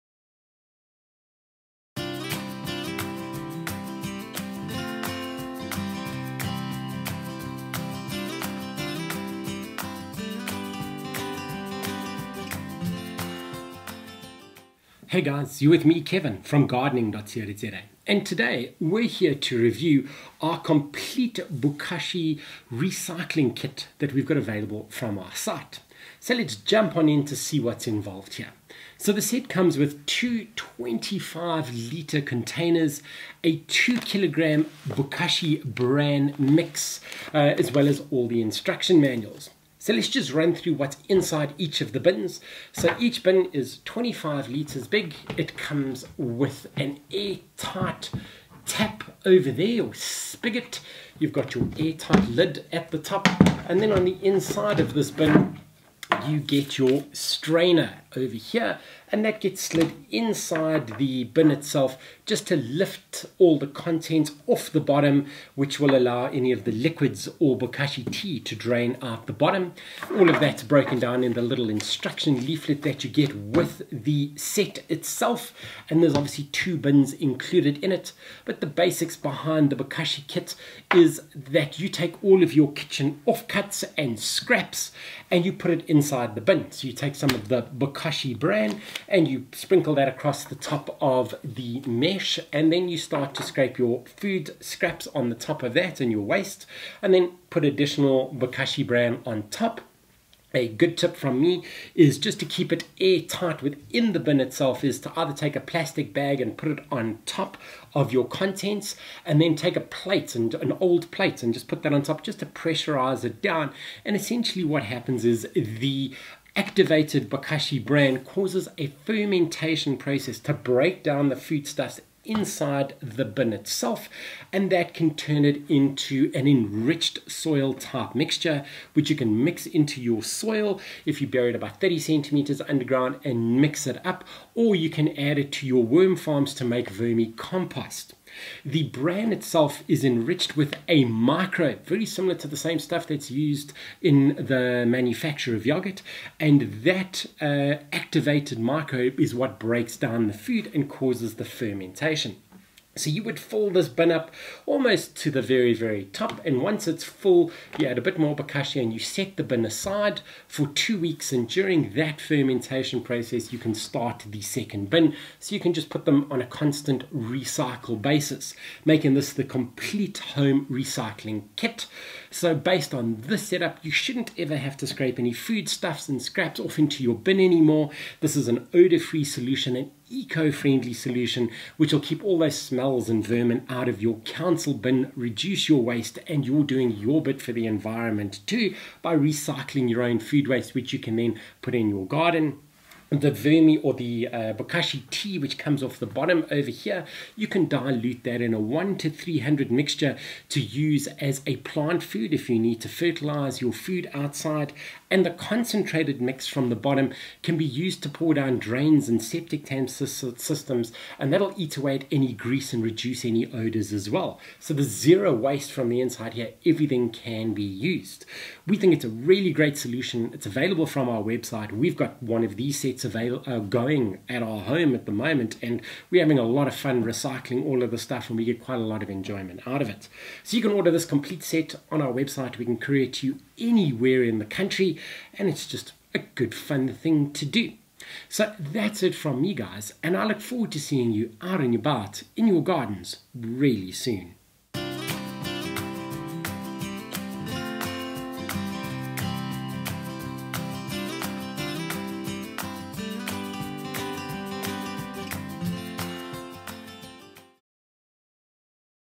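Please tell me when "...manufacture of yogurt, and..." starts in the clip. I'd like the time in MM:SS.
02:24.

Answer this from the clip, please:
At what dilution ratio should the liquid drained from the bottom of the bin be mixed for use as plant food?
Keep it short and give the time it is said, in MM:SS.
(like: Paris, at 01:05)
1 to 300, at 03:18.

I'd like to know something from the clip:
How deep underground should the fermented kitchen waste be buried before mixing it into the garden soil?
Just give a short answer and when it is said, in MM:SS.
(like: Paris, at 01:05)
30 centimeters, at 02:11.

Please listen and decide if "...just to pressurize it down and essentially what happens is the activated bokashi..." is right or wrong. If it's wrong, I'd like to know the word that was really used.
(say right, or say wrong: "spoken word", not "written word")
right.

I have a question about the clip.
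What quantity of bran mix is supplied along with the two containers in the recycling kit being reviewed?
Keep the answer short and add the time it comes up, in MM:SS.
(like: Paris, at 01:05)
2 kilograms, at 00:33.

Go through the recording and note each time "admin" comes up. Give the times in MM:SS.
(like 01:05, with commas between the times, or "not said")
not said.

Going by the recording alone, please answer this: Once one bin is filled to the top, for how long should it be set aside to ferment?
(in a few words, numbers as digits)
Two weeks.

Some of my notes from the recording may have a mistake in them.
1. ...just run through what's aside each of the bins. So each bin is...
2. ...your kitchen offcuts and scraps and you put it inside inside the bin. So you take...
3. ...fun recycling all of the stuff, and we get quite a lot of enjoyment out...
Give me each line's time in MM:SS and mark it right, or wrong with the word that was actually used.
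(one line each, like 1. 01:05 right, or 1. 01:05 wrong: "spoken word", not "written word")
1. 00:40 wrong: "inside", not "aside"
2. 01:22 right
3. 03:46 right.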